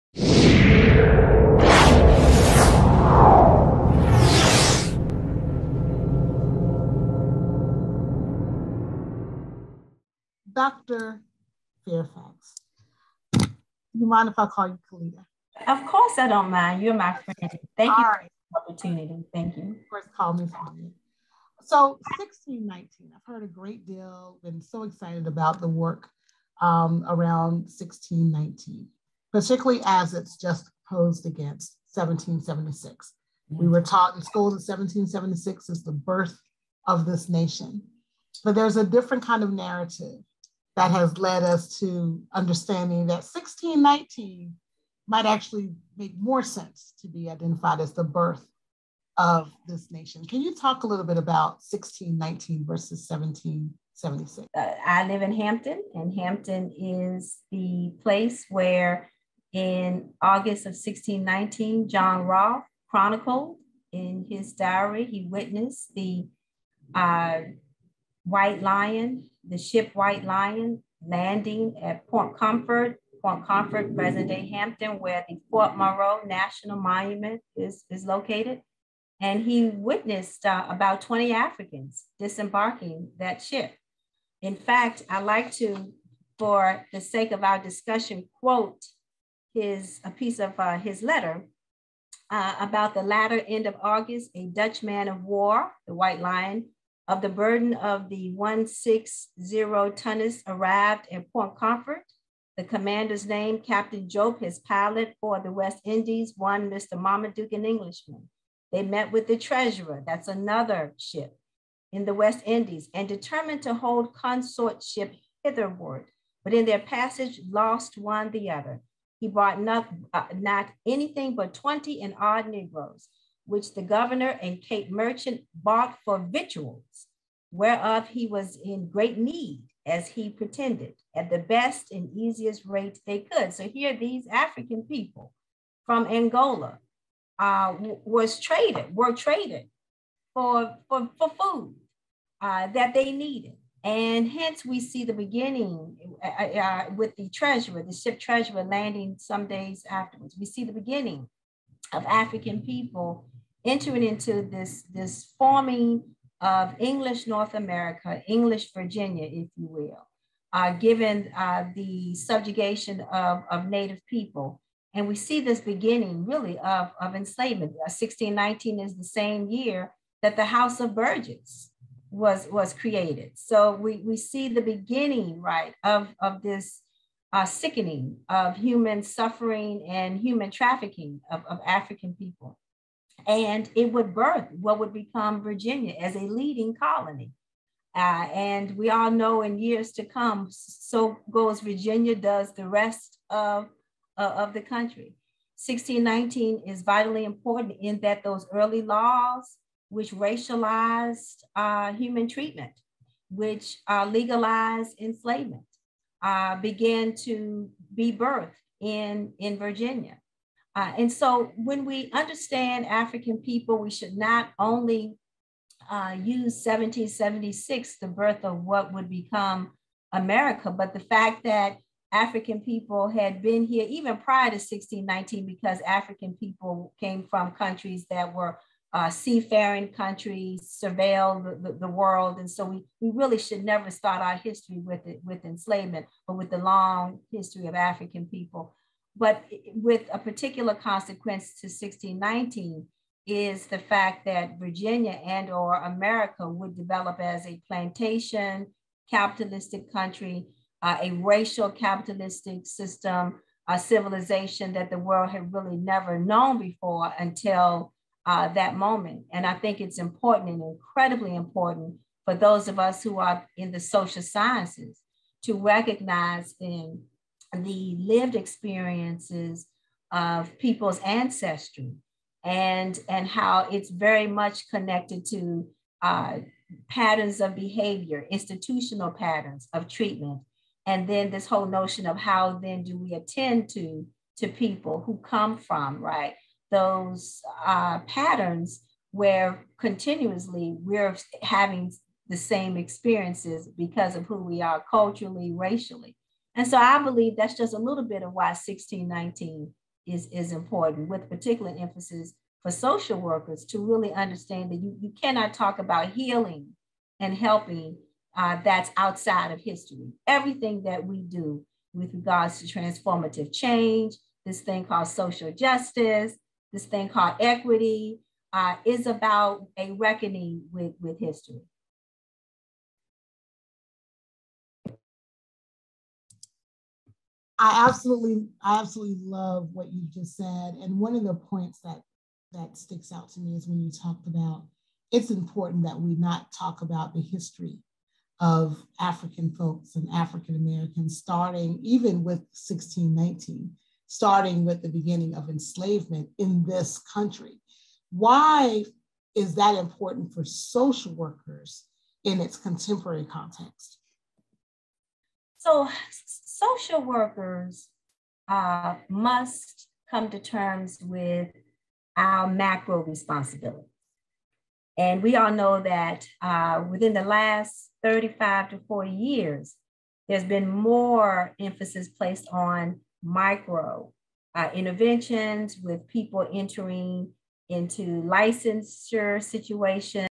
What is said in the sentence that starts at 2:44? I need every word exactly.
And we see this beginning really of, of enslavement.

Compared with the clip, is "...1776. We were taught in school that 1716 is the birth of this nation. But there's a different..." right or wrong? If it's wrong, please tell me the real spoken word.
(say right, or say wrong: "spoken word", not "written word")
wrong: "1776", not "1716".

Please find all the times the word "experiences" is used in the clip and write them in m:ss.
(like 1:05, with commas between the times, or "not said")
4:28, 4:52.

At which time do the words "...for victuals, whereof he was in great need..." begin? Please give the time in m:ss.
2:06.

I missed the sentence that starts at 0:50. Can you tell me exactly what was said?
Can you talk a little bit about 1619 versus 1776?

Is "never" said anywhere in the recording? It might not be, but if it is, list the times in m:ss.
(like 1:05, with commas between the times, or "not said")
3:53, 4:15.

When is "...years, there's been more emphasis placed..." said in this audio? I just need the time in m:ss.
6:09.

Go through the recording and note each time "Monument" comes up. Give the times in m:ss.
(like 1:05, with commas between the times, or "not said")
1:16.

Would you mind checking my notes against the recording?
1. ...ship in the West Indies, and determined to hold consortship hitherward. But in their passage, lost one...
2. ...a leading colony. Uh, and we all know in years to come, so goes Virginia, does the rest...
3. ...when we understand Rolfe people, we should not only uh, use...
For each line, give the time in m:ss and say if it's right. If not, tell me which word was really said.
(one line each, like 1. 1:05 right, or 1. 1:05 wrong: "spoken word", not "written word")
1. 1:50 right
2. 3:06 right
3. 3:31 wrong: "African", not "Rolfe".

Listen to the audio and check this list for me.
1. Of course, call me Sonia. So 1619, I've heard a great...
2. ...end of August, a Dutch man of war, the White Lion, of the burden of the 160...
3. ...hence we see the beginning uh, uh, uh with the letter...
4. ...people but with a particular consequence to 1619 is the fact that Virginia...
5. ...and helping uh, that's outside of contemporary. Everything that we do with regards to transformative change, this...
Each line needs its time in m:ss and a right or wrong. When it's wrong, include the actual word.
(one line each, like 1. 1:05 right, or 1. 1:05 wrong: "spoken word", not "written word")
1. 0:19 right
2. 1:33 right
3. 2:24 wrong: "treasurer", not "letter"
4. 3:58 right
5. 5:07 wrong: "history", not "contemporary".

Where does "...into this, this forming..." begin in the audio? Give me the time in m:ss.
2:34.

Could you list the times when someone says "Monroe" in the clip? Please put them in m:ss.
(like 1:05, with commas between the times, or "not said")
1:15.